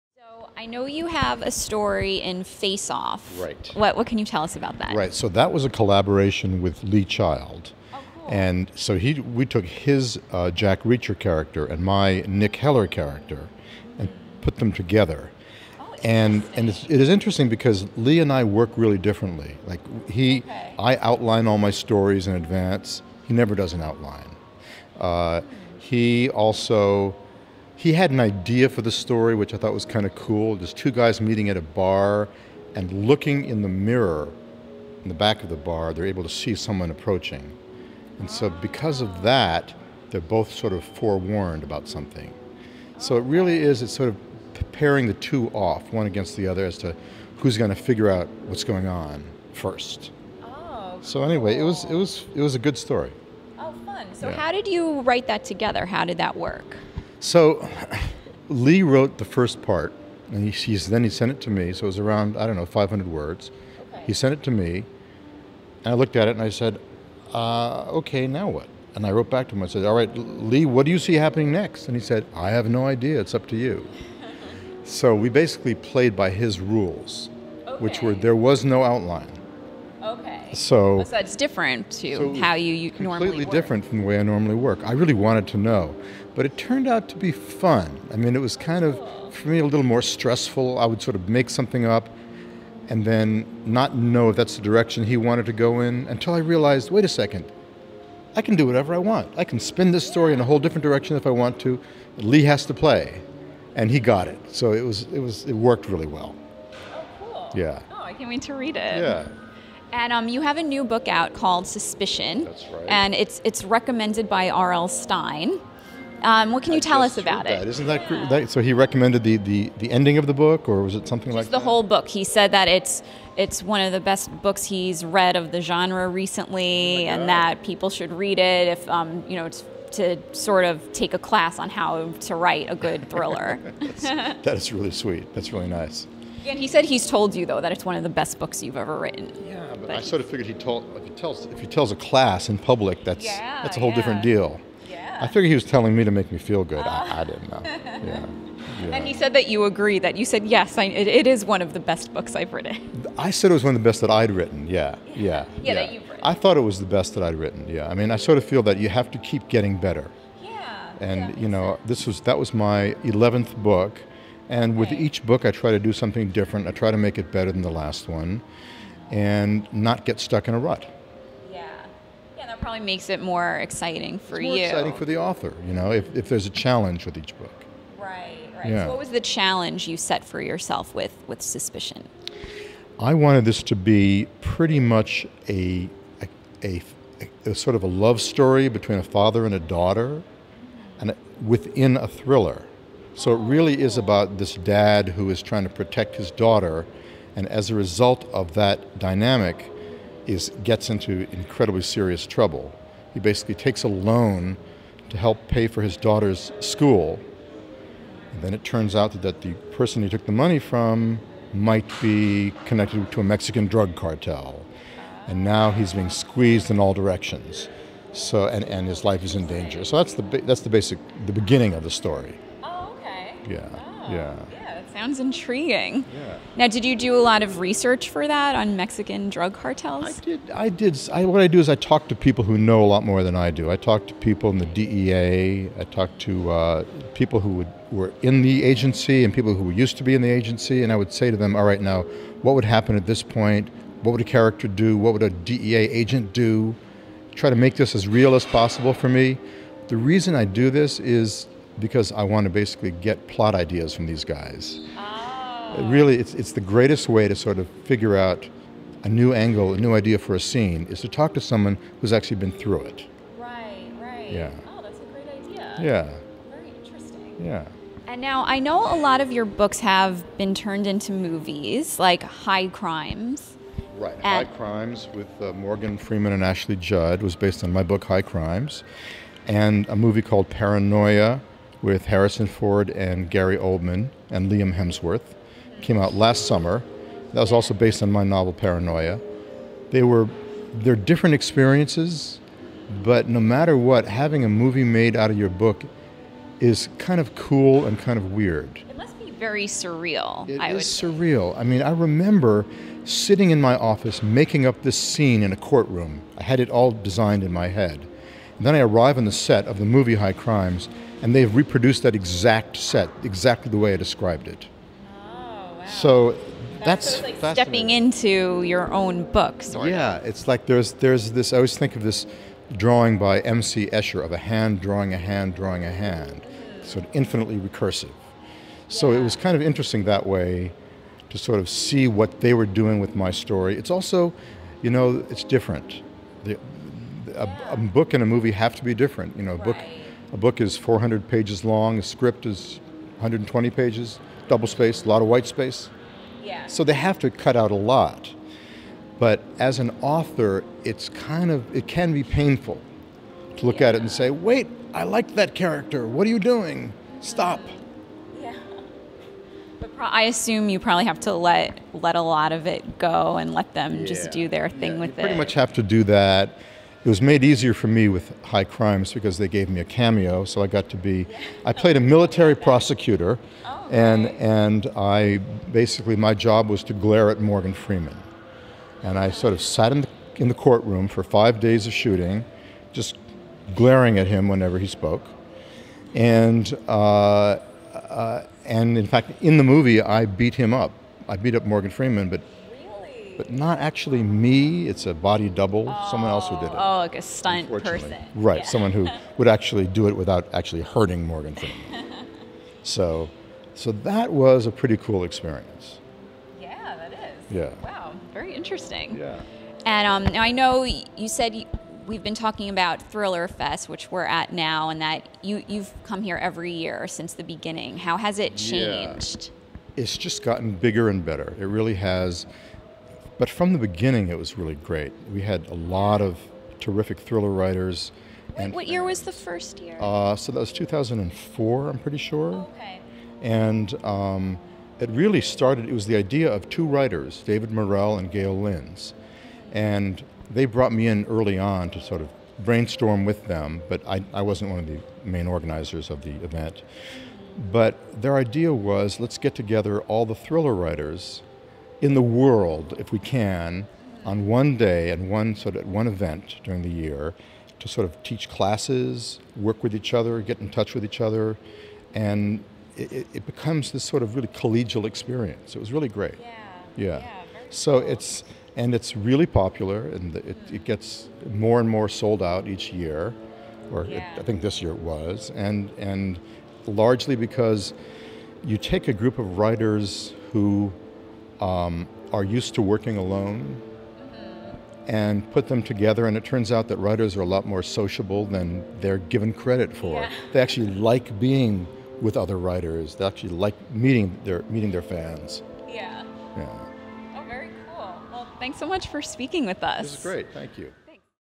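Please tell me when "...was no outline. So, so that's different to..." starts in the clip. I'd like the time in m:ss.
1:18.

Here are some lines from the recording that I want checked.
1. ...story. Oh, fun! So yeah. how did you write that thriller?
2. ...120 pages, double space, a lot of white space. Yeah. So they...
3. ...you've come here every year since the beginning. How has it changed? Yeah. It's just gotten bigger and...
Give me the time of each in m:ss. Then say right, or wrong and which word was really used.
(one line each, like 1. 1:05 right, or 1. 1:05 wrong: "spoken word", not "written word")
1. 0:52 wrong: "together", not "thriller"
2. 5:43 right
3. 6:55 right.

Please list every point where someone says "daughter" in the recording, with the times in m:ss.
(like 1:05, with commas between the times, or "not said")
3:09, 3:16, 3:25.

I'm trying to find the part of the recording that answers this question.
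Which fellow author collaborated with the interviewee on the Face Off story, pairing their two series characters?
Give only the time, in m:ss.
0:06.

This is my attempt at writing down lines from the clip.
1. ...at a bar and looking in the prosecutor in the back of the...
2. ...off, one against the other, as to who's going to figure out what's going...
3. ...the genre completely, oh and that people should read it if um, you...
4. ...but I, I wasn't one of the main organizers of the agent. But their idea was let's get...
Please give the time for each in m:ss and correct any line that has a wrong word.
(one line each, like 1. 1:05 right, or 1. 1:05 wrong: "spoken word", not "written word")
1. 0:31 wrong: "mirror", not "prosecutor"
2. 0:45 right
3. 2:05 wrong: "recently", not "completely"
4. 7:23 wrong: "event", not "agent".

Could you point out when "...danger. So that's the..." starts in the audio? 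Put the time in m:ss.
3:39.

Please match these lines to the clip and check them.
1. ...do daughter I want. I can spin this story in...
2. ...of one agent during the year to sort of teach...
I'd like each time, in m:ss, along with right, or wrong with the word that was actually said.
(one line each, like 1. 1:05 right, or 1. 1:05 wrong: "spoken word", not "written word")
1. 1:38 wrong: "whatever", not "daughter"
2. 7:35 wrong: "event", not "agent".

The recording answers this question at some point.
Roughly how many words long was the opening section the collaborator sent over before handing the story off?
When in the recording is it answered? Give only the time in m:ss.
1:02.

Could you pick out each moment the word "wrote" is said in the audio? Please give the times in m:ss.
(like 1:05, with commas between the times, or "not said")
0:58, 1:09.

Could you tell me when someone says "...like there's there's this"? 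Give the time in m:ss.
5:20.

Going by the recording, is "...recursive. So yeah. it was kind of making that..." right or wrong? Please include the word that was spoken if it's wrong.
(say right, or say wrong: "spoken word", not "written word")
wrong: "interesting", not "making".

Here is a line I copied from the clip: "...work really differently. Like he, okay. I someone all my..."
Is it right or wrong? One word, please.
wrong.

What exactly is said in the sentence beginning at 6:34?
It's a body double, oh, someone else who did it.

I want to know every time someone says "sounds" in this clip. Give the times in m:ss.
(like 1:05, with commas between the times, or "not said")
3:44.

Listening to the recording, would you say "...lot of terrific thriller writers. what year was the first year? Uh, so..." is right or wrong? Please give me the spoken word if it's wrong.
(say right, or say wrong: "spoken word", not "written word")
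right.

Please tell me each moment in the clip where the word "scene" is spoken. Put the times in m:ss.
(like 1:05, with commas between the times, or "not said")
4:20, 5:04.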